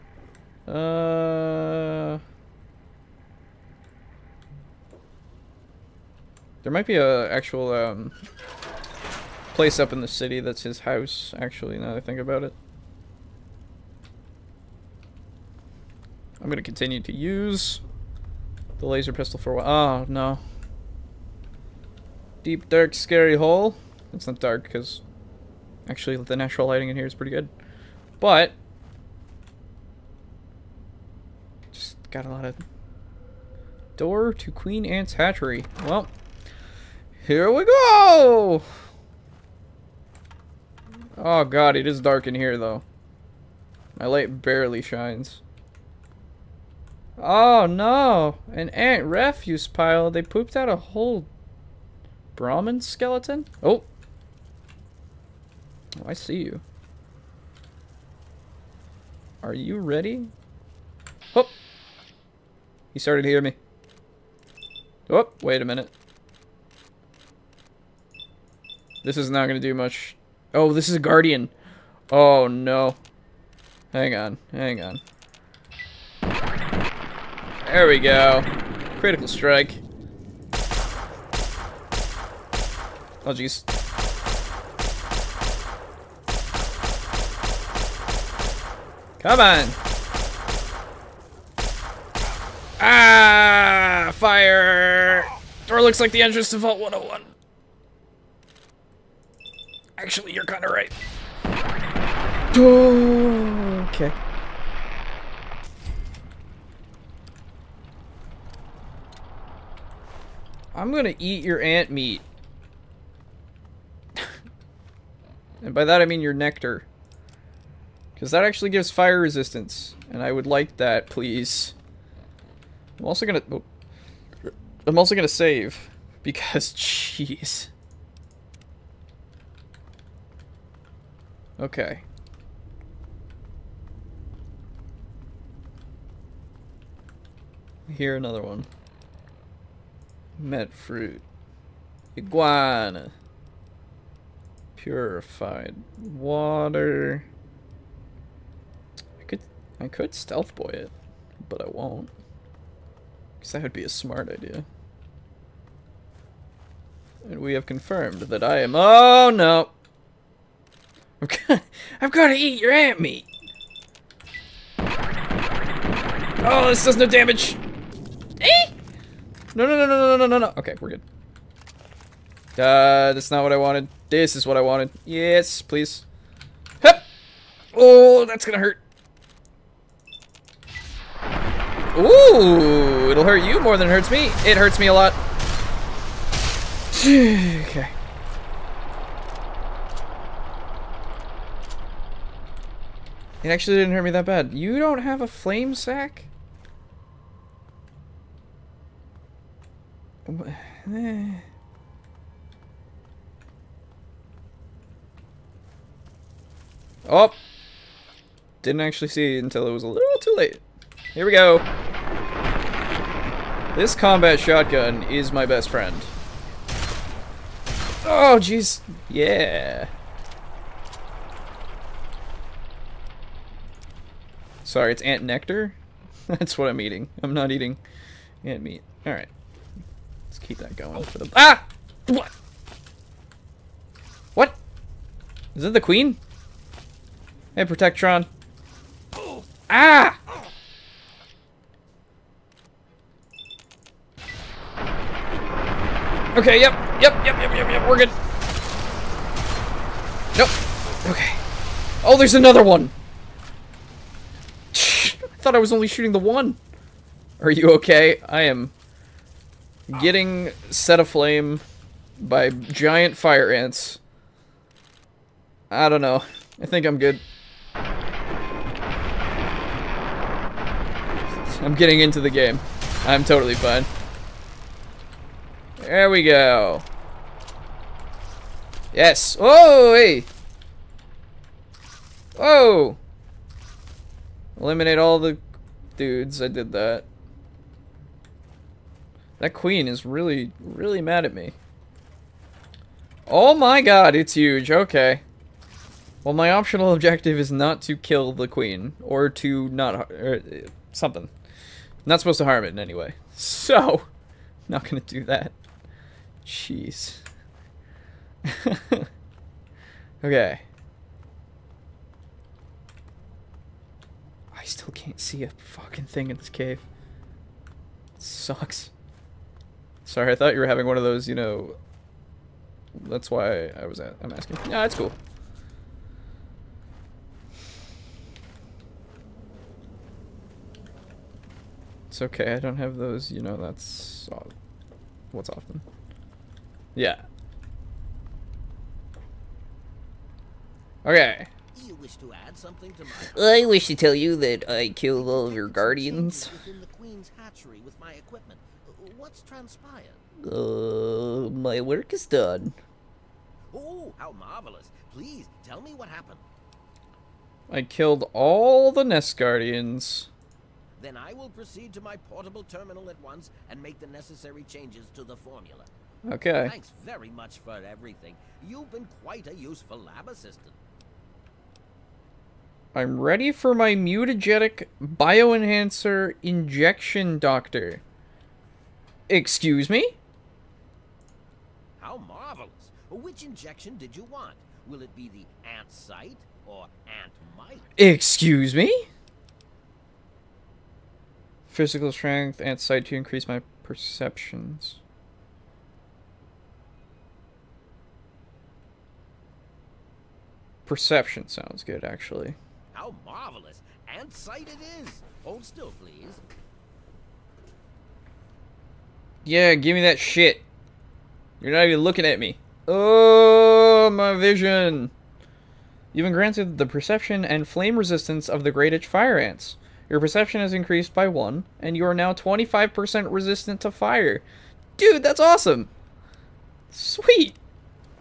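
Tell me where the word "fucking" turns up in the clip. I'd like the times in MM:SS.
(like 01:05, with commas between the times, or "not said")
05:15.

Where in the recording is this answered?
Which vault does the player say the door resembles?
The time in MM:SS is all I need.
01:36.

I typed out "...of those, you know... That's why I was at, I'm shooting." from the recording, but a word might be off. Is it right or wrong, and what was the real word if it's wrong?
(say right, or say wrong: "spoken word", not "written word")
wrong: "asking", not "shooting".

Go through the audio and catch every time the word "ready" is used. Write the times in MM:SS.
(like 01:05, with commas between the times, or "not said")
00:59, 06:13.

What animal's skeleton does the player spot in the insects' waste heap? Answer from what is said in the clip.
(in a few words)
Brahmin.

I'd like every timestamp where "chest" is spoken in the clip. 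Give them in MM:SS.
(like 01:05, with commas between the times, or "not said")
not said.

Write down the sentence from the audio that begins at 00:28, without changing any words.
But just got a lot of door to Queen ants Hatchery.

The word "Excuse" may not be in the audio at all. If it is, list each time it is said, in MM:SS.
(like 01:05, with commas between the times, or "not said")
06:19, 06:27.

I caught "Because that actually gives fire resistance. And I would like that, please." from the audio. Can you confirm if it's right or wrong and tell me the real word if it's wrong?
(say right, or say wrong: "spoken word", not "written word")
right.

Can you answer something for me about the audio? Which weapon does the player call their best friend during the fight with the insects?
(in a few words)
Combat shotgun.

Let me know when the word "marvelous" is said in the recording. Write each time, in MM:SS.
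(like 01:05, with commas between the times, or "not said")
05:54, 06:22, 06:43.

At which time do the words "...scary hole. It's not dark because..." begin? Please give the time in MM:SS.
00:22.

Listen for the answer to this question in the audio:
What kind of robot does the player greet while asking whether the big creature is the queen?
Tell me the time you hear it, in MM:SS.
03:57.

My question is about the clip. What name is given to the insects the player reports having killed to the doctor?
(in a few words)
Nest Guardians.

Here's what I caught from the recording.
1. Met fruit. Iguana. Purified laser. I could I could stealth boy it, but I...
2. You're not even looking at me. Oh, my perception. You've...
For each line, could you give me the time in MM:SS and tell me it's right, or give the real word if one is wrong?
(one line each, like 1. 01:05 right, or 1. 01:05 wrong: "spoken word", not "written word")
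1. 02:20 wrong: "water", not "laser"
2. 06:51 wrong: "vision", not "perception".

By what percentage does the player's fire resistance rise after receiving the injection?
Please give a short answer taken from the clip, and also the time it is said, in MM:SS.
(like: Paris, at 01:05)
25%, at 07:02.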